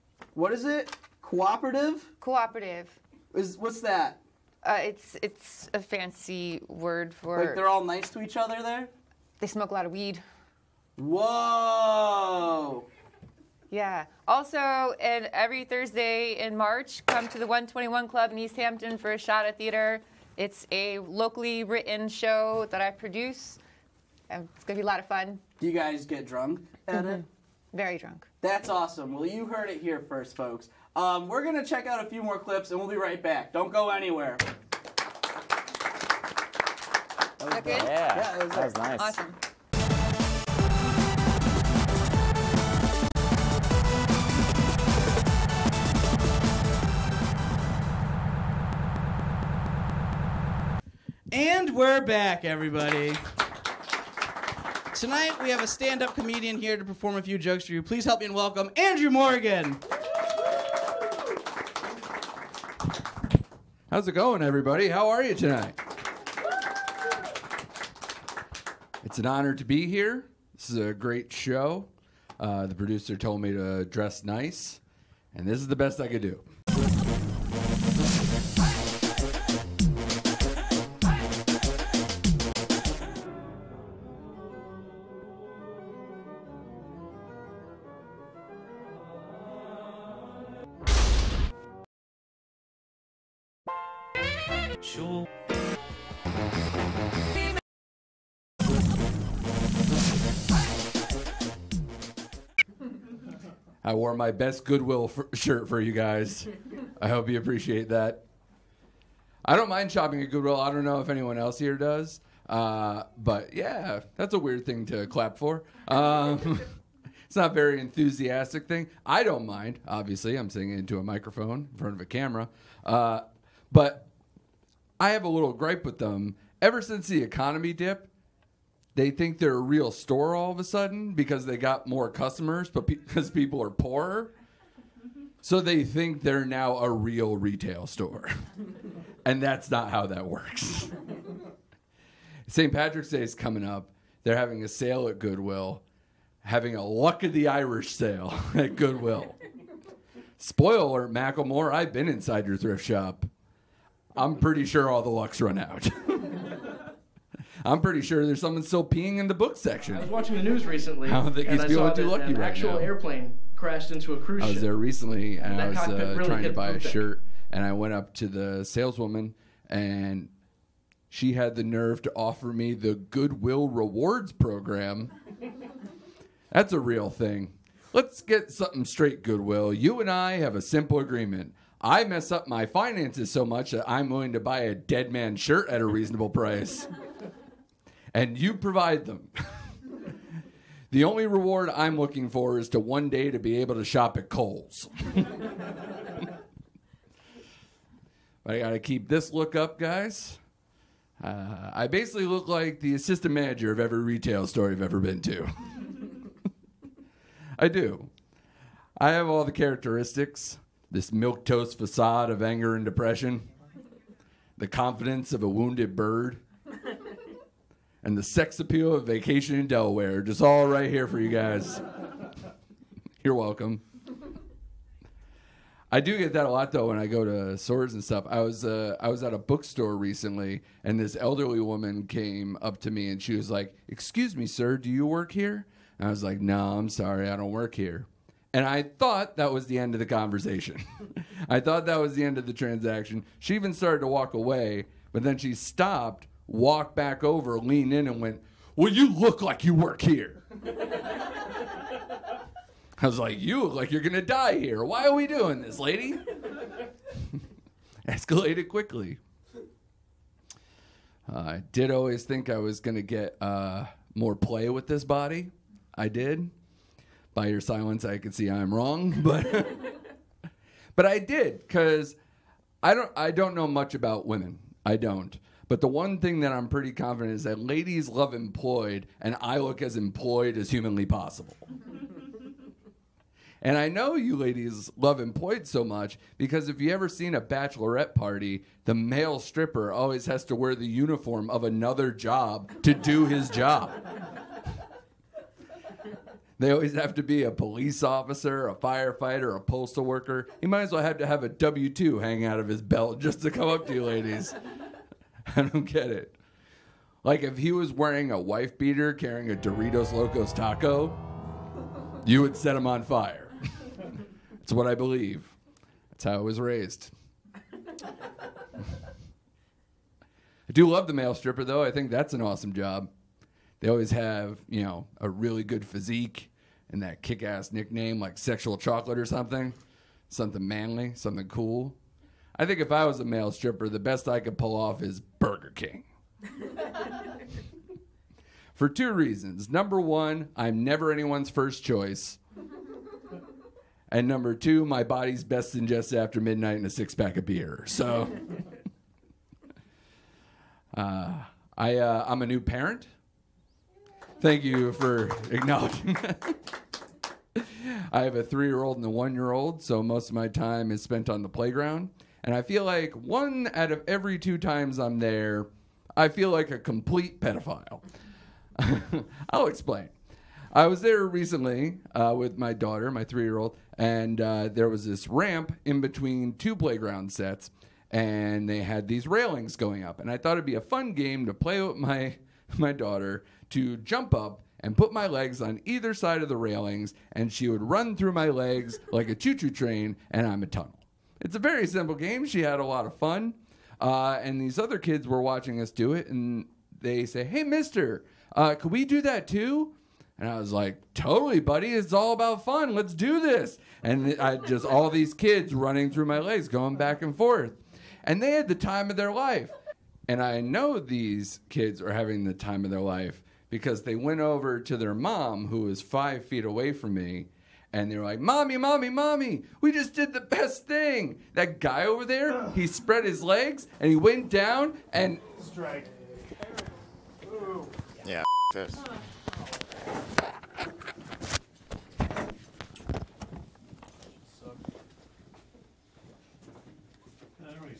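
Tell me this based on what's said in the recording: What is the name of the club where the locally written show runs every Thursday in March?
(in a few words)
121 Club.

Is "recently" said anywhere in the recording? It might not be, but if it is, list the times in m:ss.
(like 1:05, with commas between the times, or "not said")
2:40, 2:44, 3:49, 6:11.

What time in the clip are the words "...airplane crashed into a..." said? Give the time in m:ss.
2:42.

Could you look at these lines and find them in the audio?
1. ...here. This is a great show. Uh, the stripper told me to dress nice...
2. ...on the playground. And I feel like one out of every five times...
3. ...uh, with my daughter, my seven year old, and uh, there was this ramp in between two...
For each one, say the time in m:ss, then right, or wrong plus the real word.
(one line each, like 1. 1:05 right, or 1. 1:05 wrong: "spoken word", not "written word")
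1. 1:09 wrong: "producer", not "stripper"
2. 6:01 wrong: "two", not "five"
3. 6:12 wrong: "three", not "seven".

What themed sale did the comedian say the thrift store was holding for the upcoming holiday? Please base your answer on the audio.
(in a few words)
Luck of the Irish sale.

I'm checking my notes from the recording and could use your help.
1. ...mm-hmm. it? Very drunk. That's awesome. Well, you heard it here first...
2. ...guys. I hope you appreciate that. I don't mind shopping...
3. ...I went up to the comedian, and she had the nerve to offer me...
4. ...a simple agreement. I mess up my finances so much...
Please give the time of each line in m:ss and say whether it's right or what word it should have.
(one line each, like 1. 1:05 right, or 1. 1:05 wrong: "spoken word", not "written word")
1. 0:26 right
2. 1:45 right
3. 2:47 wrong: "saleswoman", not "comedian"
4. 3:00 right.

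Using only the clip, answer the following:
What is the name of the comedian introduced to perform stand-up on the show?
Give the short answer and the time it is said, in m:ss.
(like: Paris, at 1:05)
Andrew Morgan, at 0:58.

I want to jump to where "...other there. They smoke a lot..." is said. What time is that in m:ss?
0:08.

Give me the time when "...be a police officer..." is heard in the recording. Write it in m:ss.
4:57.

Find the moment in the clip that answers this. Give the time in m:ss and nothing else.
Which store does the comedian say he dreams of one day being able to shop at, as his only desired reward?
3:14.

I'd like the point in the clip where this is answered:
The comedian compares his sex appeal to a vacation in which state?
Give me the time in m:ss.
3:39.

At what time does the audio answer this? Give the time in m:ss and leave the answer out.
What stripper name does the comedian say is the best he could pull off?
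5:35.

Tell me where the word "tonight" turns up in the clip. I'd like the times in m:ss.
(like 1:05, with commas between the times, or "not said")
0:54, 1:05.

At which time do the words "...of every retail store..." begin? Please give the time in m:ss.
3:23.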